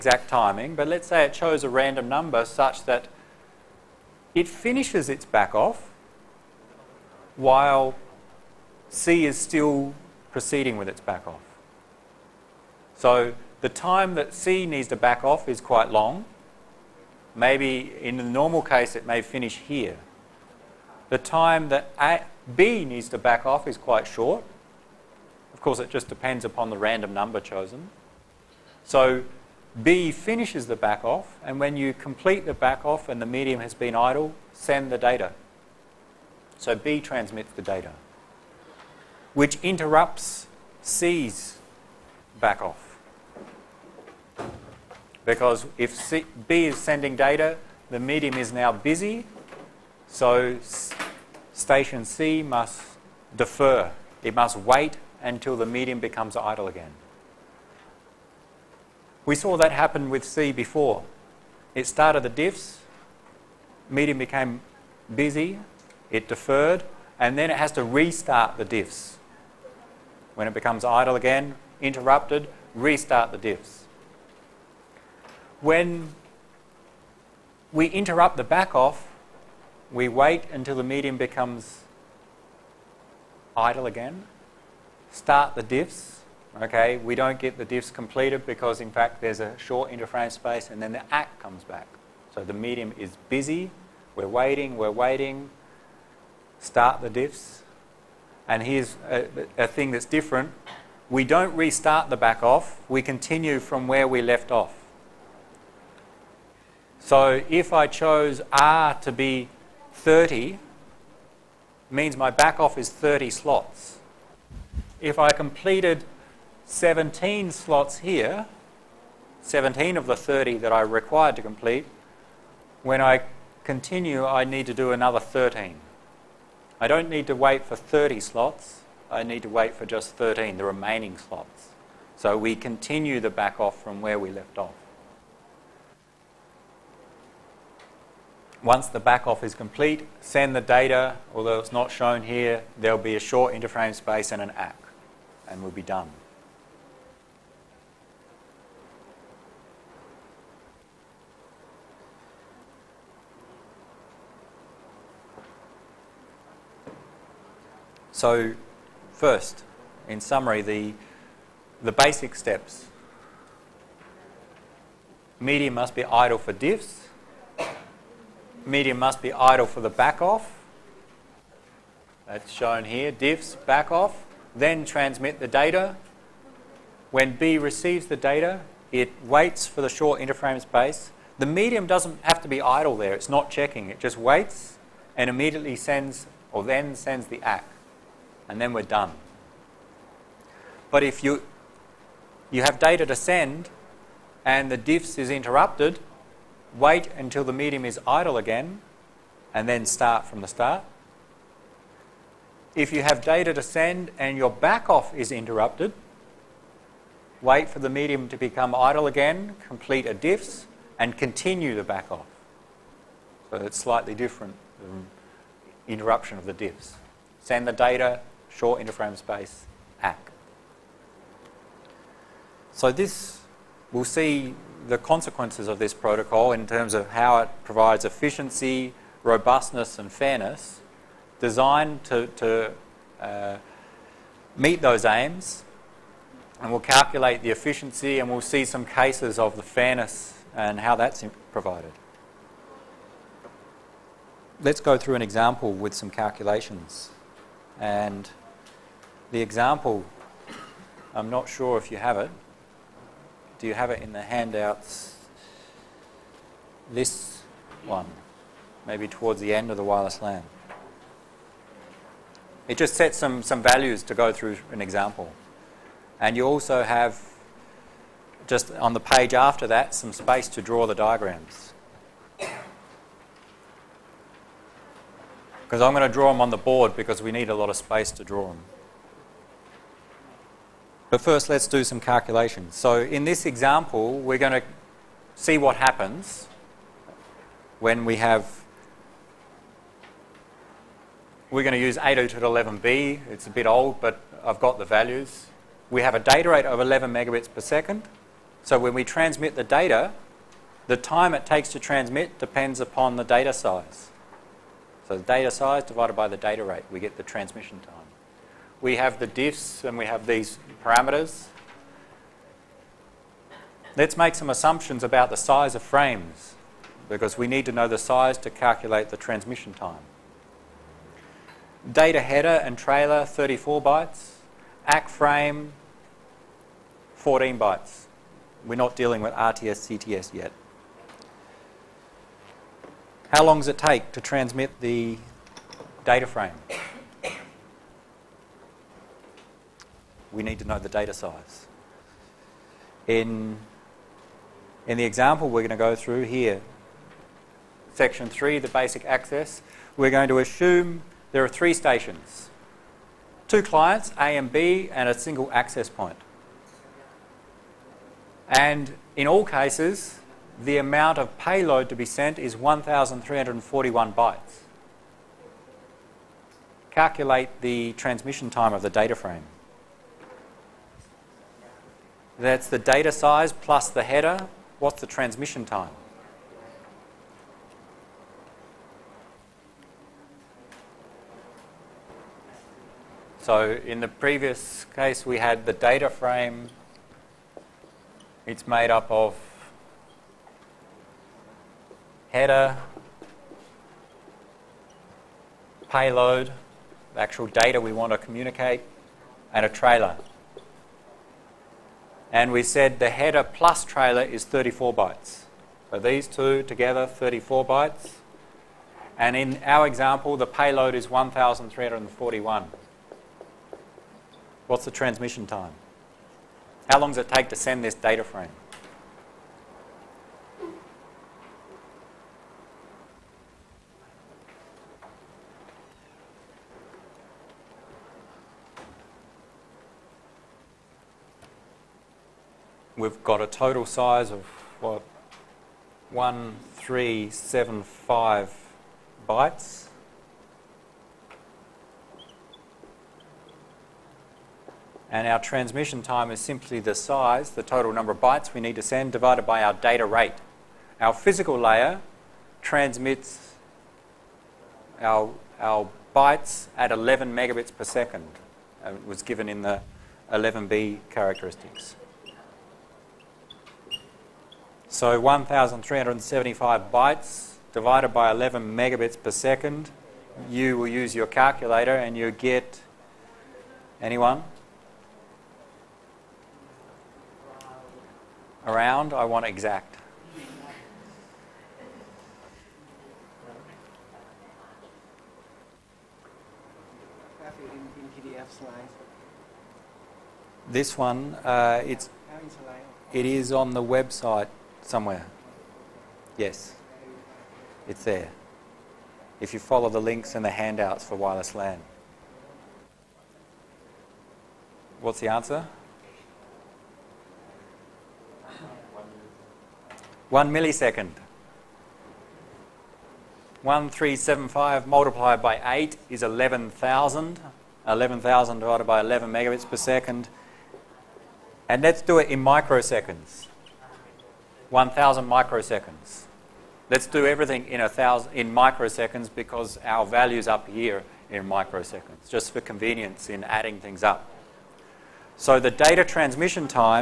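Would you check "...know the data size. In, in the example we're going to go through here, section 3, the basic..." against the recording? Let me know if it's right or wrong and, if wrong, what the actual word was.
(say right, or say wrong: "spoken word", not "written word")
right.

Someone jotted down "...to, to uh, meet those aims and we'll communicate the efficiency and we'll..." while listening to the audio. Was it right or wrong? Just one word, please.
wrong.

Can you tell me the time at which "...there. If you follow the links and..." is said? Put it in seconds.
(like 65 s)
498 s.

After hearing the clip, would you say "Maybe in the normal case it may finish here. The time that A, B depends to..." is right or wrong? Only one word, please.
wrong.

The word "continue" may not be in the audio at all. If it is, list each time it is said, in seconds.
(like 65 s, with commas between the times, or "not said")
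103 s, 123 s, 132 s, 211 s.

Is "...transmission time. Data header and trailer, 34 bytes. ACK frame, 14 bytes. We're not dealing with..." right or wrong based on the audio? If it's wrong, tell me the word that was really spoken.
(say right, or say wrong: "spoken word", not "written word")
right.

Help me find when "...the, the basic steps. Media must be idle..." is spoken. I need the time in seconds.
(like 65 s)
160 s.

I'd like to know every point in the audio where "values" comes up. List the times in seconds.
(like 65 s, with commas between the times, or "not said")
263 s, 294 s, 530 s.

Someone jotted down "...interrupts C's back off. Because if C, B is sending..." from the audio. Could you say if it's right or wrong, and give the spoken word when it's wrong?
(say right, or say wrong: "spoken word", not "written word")
right.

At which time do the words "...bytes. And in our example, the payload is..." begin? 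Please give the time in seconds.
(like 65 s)
407 s.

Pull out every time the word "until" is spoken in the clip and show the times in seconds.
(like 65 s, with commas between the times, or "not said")
55 s, 80 s, 197 s.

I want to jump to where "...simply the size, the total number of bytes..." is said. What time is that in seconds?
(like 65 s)
446 s.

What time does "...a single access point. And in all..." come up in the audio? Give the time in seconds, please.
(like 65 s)
355 s.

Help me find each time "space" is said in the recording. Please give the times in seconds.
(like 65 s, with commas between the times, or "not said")
90 s, 143 s, 180 s, 219 s, 270 s, 277 s.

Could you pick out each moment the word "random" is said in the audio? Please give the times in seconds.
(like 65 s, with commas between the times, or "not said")
1 s, 26 s.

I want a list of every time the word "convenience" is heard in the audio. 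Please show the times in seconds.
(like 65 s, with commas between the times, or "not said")
532 s.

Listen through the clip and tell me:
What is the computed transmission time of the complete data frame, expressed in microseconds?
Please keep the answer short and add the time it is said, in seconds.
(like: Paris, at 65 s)
1,000 microseconds, at 524 s.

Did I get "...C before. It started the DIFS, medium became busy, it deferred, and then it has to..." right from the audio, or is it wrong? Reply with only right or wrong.
right.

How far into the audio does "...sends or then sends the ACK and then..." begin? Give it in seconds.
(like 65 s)
185 s.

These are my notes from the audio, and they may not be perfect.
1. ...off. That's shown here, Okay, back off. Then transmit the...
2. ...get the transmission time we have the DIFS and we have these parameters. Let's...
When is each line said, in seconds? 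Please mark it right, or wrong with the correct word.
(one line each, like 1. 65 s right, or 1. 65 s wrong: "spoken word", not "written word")
1. 170 s wrong: "DIFS", not "Okay"
2. 306 s right.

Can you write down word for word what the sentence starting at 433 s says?
we've got a total size of what 1375 bytes.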